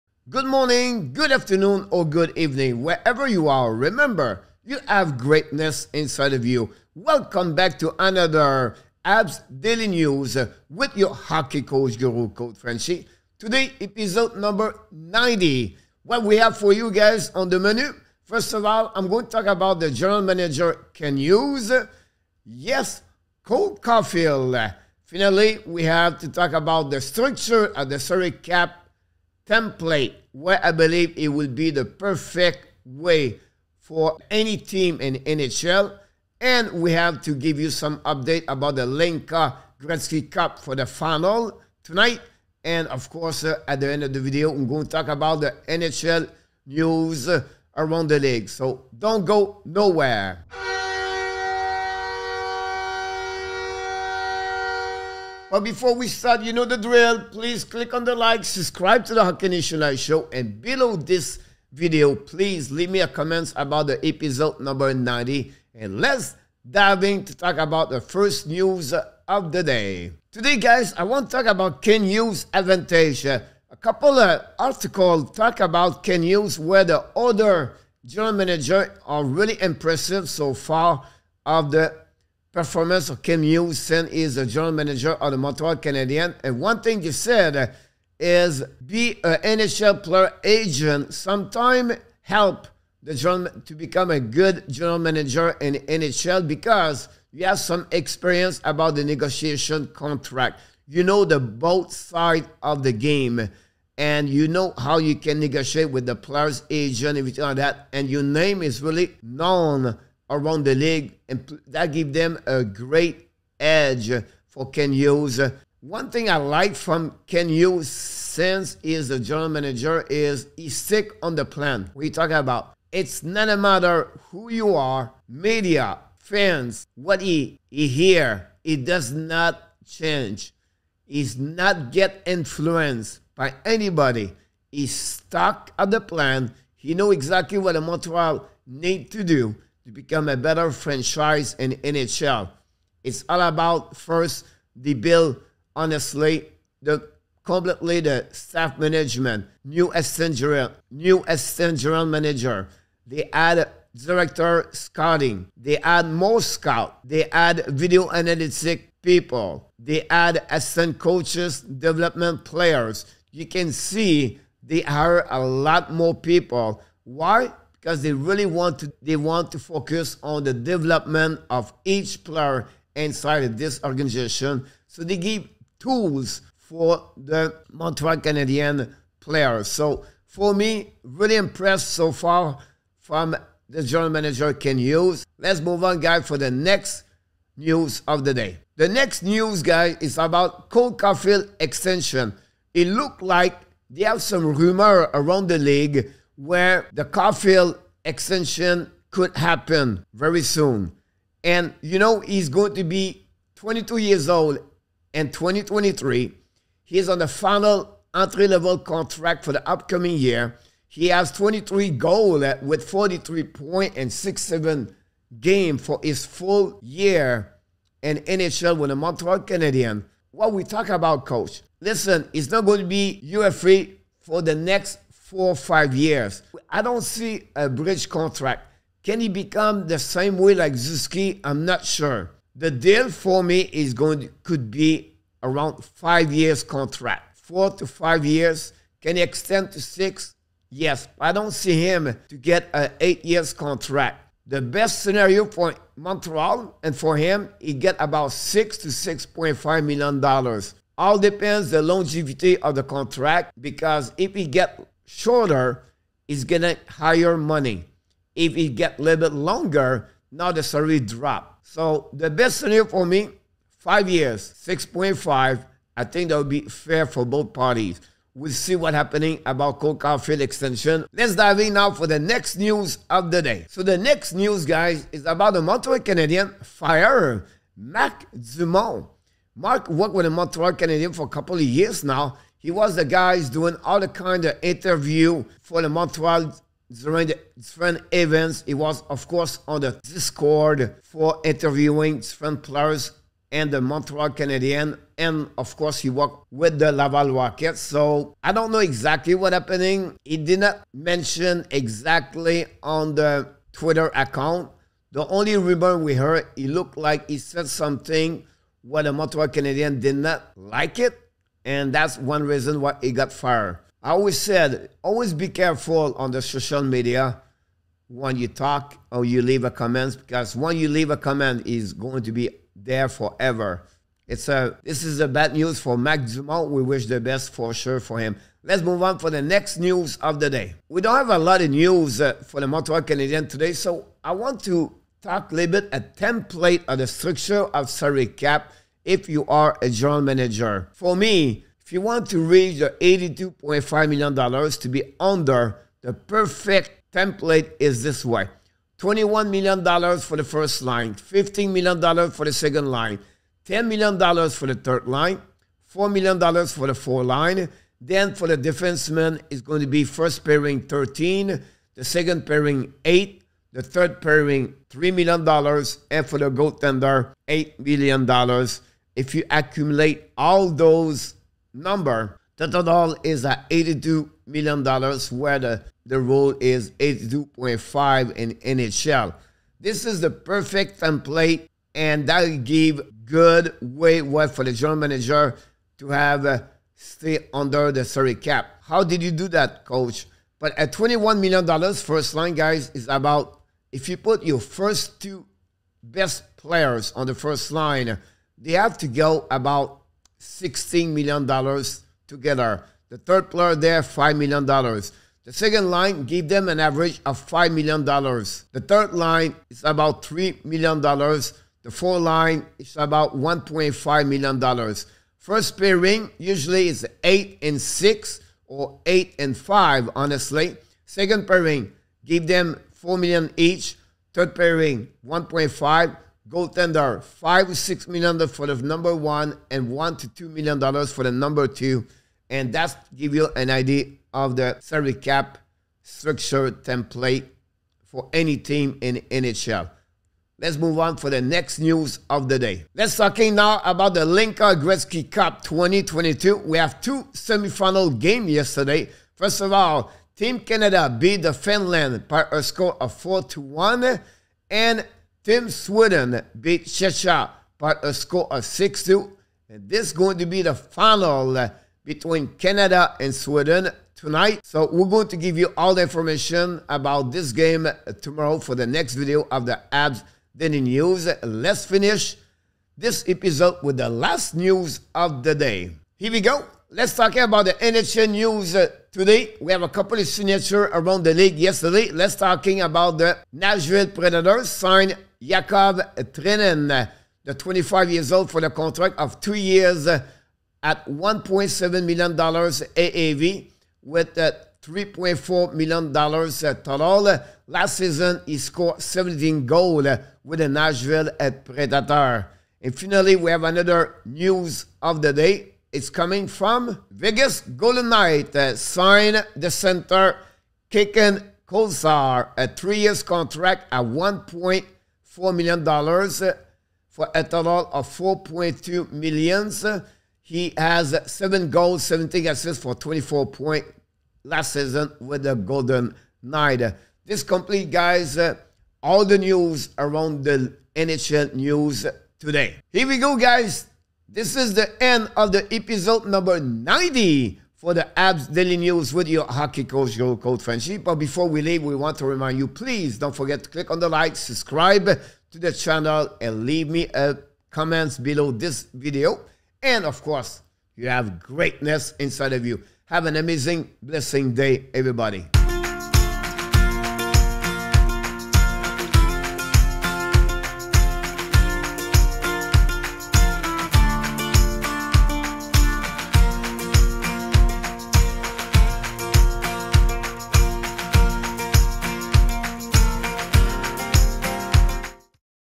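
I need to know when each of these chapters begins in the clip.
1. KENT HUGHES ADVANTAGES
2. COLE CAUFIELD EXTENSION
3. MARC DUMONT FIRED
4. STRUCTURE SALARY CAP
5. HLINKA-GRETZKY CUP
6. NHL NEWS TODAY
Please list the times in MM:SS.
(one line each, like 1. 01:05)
1. 01:10
2. 03:10
3. 04:35
4. 05:31
5. 07:23
6. 07:56.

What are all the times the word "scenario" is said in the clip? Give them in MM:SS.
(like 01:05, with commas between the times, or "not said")
04:05, 04:22.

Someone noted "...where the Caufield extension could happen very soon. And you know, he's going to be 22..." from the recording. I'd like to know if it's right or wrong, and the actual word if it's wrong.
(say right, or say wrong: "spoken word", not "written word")
right.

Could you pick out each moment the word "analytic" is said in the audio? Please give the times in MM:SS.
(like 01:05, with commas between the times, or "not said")
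02:38.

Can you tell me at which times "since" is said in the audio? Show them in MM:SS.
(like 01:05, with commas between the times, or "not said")
01:57.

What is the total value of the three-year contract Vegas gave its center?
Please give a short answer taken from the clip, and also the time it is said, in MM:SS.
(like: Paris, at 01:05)
$4.2 million, at 08:38.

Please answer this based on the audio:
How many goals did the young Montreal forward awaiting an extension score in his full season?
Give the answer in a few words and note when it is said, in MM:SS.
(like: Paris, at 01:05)
23, at 03:31.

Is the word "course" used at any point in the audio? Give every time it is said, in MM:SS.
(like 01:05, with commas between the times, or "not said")
00:43, 04:49, 04:55, 09:10.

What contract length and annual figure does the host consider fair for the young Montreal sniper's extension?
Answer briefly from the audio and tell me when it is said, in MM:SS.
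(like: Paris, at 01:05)
5 years, $6.5 million, at 04:23.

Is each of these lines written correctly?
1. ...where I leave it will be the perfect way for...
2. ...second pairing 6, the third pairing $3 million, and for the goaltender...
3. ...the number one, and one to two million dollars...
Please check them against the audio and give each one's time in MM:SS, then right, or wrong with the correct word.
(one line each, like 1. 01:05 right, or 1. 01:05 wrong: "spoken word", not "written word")
1. 00:30 wrong: "believe", not "leave"
2. 06:02 wrong: "8", not "6"
3. 07:08 right.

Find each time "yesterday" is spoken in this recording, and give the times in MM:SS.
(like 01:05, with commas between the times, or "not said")
07:28, 08:01.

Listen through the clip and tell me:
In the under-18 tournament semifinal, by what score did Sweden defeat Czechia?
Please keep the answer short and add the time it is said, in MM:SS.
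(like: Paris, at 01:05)
6-2, at 07:38.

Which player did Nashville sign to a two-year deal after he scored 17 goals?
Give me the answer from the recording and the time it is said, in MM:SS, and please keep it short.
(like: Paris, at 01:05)
Yakov Trenin, at 08:05.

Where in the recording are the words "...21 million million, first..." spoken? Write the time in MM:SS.
06:30.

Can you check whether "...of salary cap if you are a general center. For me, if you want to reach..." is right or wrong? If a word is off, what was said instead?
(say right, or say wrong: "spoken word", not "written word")
wrong: "manager", not "center".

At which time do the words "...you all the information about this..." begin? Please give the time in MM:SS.
07:45.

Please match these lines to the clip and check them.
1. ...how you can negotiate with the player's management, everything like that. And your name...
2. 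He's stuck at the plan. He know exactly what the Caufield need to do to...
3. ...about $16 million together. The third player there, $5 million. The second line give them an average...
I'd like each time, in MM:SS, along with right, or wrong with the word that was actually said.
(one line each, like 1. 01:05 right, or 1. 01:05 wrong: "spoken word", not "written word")
1. 01:44 wrong: "agent", not "management"
2. 02:14 wrong: "Montreal", not "Caufield"
3. 06:39 right.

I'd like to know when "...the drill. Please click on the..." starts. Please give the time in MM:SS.
00:56.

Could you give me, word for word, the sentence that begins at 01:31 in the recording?
Sometime help the general, to become a good general manager in NHL because you have some experience about the negotiation contract.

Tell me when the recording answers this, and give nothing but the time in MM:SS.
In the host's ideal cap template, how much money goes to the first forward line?
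05:48.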